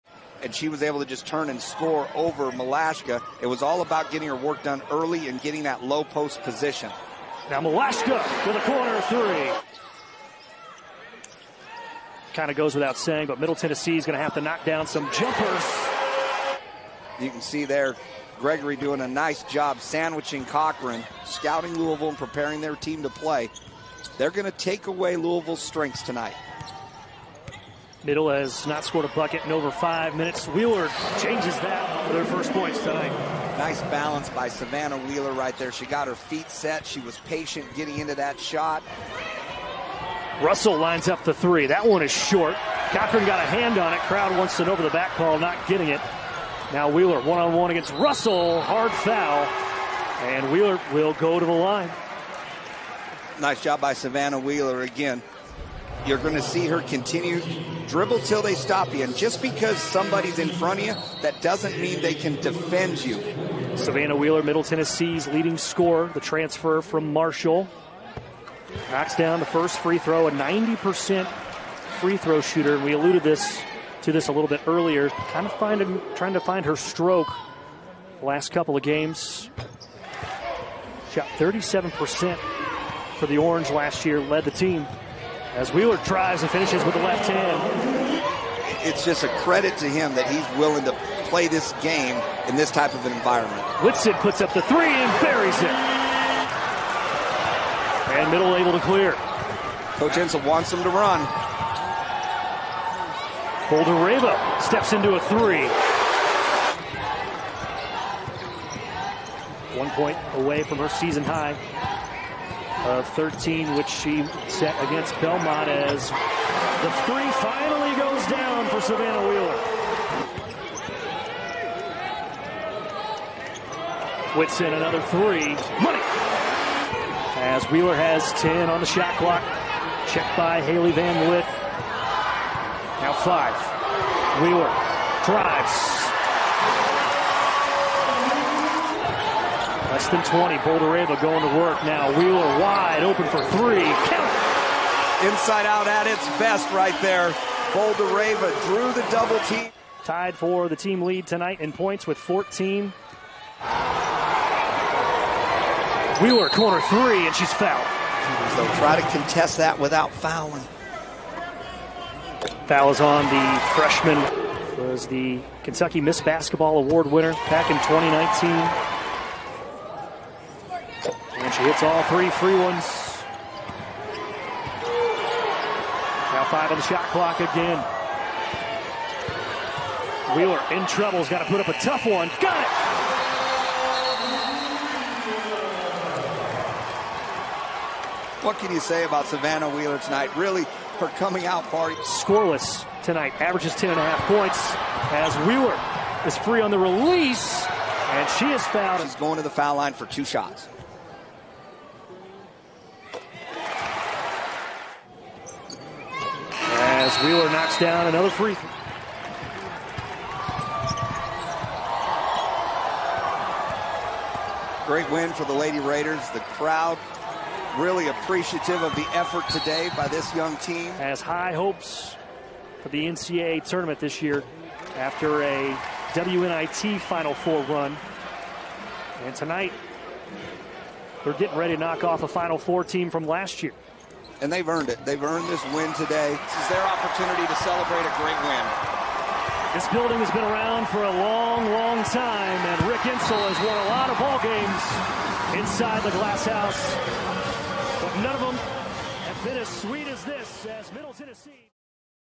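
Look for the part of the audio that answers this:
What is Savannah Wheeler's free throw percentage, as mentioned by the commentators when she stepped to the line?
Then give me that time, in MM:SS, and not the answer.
01:10.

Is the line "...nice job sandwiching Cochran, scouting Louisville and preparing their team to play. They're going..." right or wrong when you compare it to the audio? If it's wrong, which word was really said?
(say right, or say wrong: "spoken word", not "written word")
right.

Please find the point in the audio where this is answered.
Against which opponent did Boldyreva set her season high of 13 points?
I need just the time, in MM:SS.
01:55.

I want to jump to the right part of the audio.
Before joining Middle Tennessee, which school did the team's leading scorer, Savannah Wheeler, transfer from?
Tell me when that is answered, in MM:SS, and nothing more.
01:07.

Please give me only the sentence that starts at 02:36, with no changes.
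Wheeler corner three, and she's fouled.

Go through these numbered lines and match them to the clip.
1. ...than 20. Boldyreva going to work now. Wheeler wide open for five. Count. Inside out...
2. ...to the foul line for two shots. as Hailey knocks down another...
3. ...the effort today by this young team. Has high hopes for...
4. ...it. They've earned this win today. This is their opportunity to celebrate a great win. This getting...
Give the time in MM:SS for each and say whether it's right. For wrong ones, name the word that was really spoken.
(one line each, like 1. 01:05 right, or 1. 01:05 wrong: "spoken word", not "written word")
1. 02:20 wrong: "three", not "five"
2. 03:19 wrong: "Wheeler", not "Hailey"
3. 03:38 right
4. 03:54 wrong: "building", not "getting".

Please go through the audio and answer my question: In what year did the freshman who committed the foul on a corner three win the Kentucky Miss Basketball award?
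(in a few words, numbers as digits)
2019.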